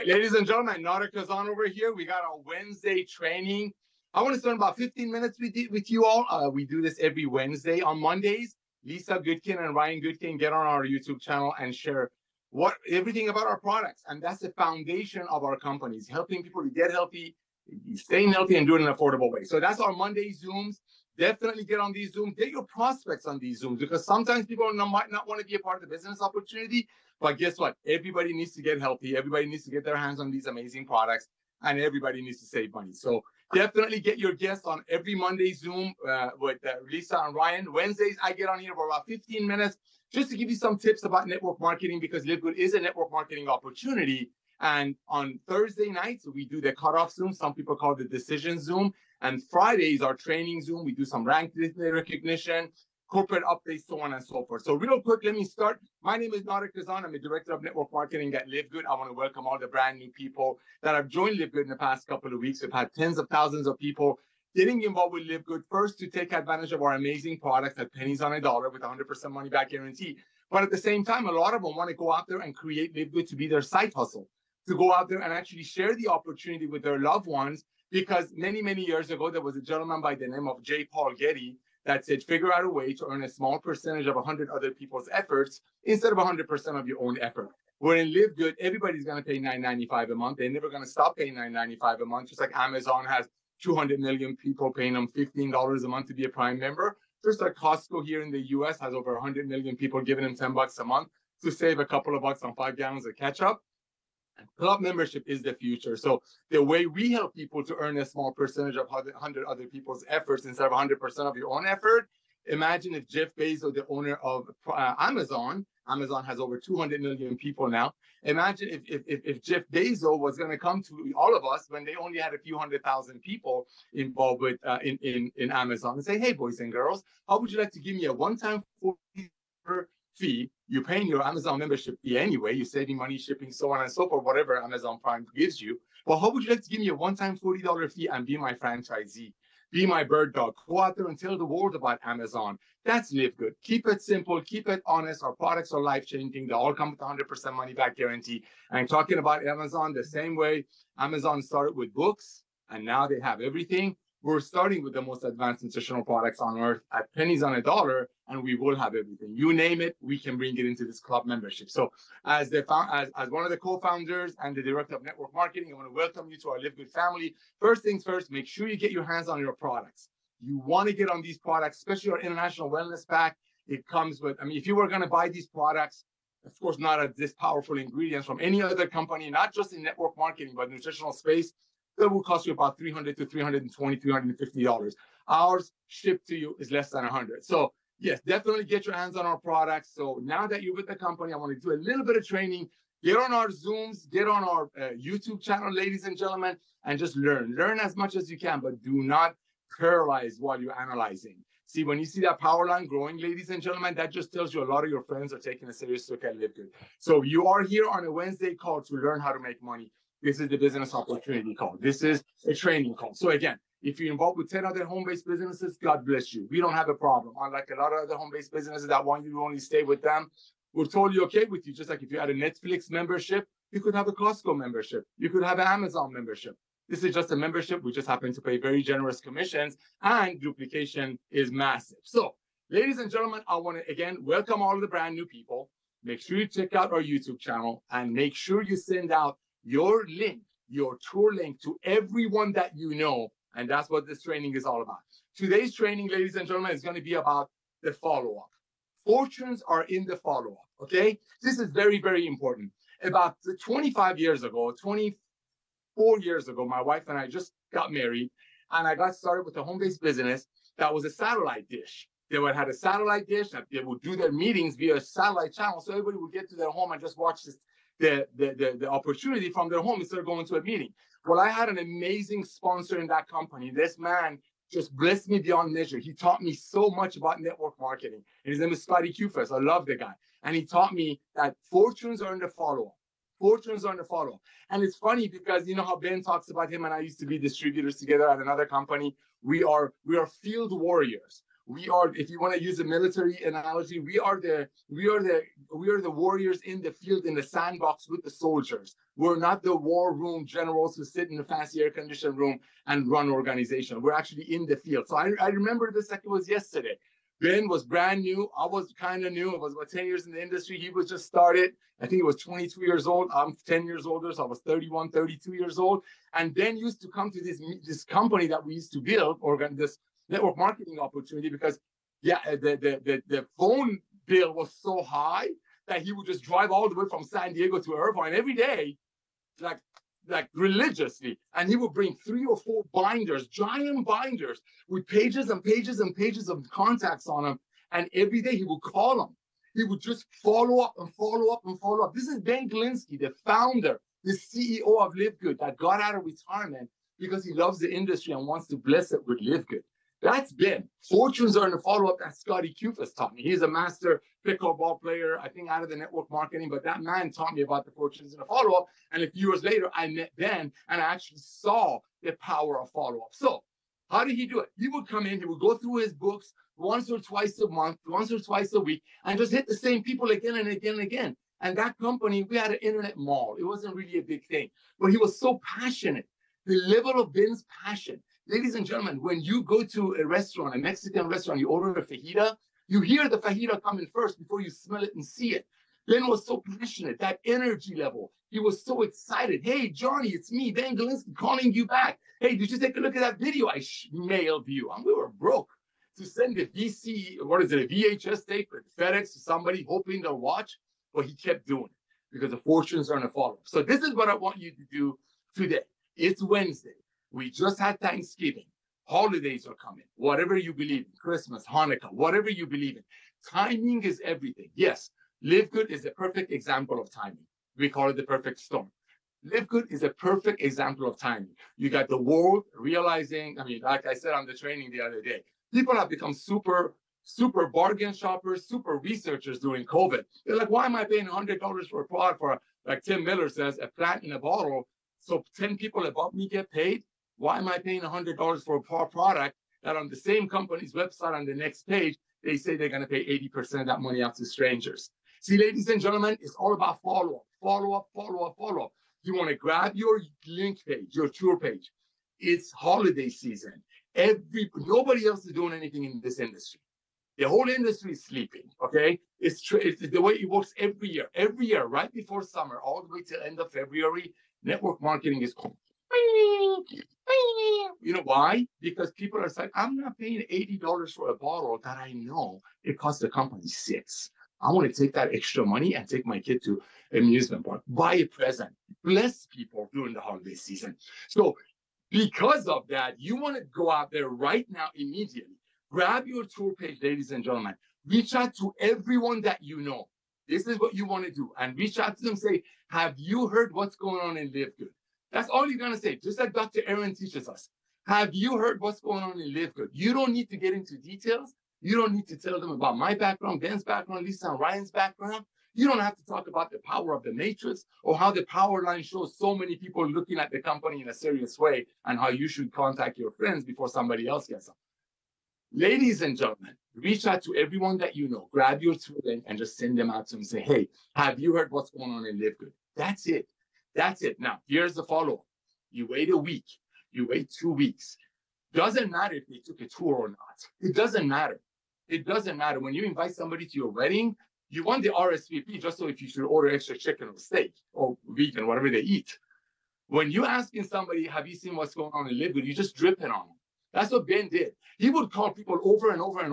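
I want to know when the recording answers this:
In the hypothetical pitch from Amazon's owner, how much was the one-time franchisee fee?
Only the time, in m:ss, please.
2:17.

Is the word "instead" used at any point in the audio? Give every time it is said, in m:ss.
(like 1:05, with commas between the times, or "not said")
1:25, 1:50, 4:30.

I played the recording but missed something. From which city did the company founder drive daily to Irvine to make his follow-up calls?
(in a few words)
San Diego.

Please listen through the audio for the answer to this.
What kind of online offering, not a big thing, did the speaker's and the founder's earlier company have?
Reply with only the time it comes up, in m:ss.
6:12.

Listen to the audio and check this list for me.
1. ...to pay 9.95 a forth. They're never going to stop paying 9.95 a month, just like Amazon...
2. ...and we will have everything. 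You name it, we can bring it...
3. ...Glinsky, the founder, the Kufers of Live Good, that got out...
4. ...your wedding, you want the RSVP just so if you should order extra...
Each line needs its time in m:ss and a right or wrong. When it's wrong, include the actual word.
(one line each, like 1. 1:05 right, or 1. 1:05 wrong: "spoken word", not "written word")
1. 1:29 wrong: "month", not "forth"
2. 2:38 right
3. 5:42 wrong: "CEO", not "Kufers"
4. 8:53 right.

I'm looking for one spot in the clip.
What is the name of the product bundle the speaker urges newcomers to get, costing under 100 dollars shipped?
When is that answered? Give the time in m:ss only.
2:52.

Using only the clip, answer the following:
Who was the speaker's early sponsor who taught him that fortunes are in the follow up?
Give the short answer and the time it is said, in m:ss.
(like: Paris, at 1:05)
Scotty Kufers, at 4:38.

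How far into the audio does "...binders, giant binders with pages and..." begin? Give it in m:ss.
5:32.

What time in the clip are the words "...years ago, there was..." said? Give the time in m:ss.
1:18.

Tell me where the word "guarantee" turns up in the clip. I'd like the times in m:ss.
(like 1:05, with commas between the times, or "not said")
1:09, 2:27.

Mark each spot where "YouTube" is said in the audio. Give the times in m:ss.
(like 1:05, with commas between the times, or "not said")
0:10, 3:15, 3:57.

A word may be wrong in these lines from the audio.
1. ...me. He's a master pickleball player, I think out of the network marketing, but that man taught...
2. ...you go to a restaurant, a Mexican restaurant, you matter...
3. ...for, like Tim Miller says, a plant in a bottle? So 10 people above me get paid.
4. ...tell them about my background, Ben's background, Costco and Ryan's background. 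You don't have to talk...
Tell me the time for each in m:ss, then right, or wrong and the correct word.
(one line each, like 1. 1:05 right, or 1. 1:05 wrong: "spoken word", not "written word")
1. 5:53 right
2. 6:19 wrong: "order", not "matter"
3. 7:12 right
4. 8:22 wrong: "Lisa", not "Costco".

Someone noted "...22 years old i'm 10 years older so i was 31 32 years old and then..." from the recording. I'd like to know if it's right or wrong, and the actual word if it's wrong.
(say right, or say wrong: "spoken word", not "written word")
right.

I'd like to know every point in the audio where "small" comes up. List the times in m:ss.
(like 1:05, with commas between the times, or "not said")
1:23, 1:48.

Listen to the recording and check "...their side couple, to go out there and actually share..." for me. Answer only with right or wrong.
wrong.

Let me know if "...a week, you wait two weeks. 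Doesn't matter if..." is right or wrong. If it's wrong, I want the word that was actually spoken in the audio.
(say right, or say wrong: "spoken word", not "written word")
right.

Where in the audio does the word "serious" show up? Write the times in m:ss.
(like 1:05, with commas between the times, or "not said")
3:25, 8:31.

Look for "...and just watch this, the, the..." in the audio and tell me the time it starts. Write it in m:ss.
4:26.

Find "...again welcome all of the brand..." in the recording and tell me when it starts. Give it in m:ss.
3:53.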